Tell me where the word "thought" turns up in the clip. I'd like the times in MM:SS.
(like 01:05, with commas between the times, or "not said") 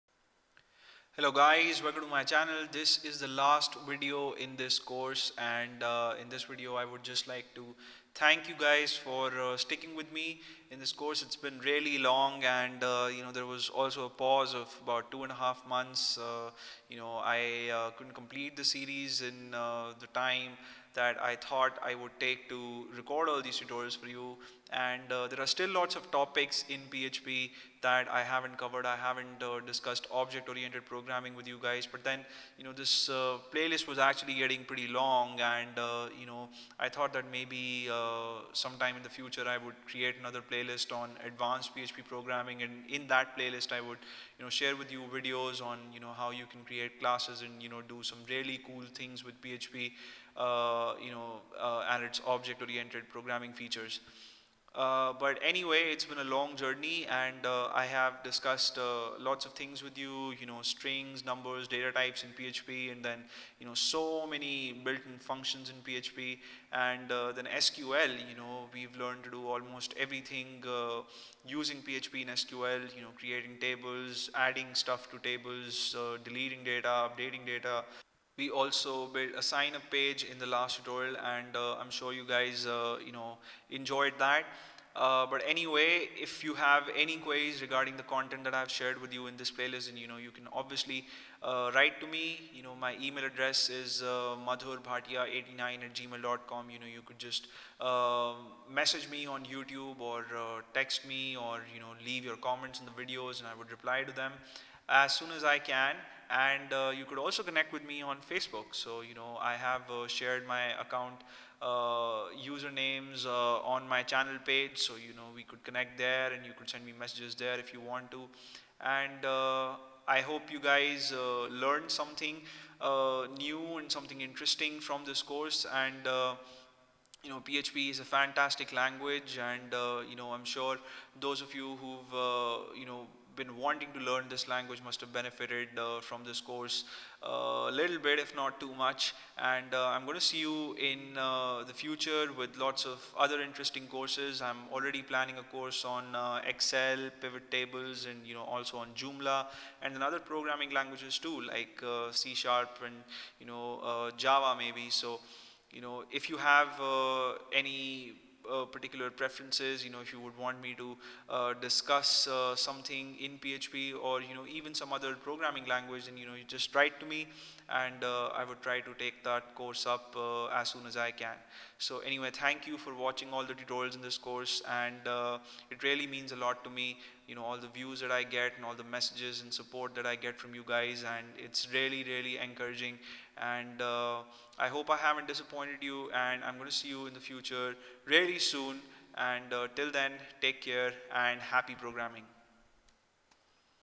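00:21, 00:36.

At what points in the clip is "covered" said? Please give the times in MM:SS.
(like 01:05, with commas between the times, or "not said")
00:28.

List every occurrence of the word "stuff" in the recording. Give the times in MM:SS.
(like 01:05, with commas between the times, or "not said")
01:14.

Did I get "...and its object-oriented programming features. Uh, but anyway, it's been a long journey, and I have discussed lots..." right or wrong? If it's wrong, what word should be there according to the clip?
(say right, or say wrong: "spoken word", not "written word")
right.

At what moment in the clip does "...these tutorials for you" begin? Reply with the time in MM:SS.
00:23.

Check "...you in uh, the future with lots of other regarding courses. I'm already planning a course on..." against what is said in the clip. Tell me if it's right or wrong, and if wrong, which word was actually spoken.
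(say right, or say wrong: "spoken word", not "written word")
wrong: "interesting", not "regarding".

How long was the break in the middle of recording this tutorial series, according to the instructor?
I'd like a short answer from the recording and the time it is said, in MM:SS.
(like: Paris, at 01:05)
2 and a half months, at 00:15.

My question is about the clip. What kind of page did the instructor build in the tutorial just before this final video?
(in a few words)
sign up page.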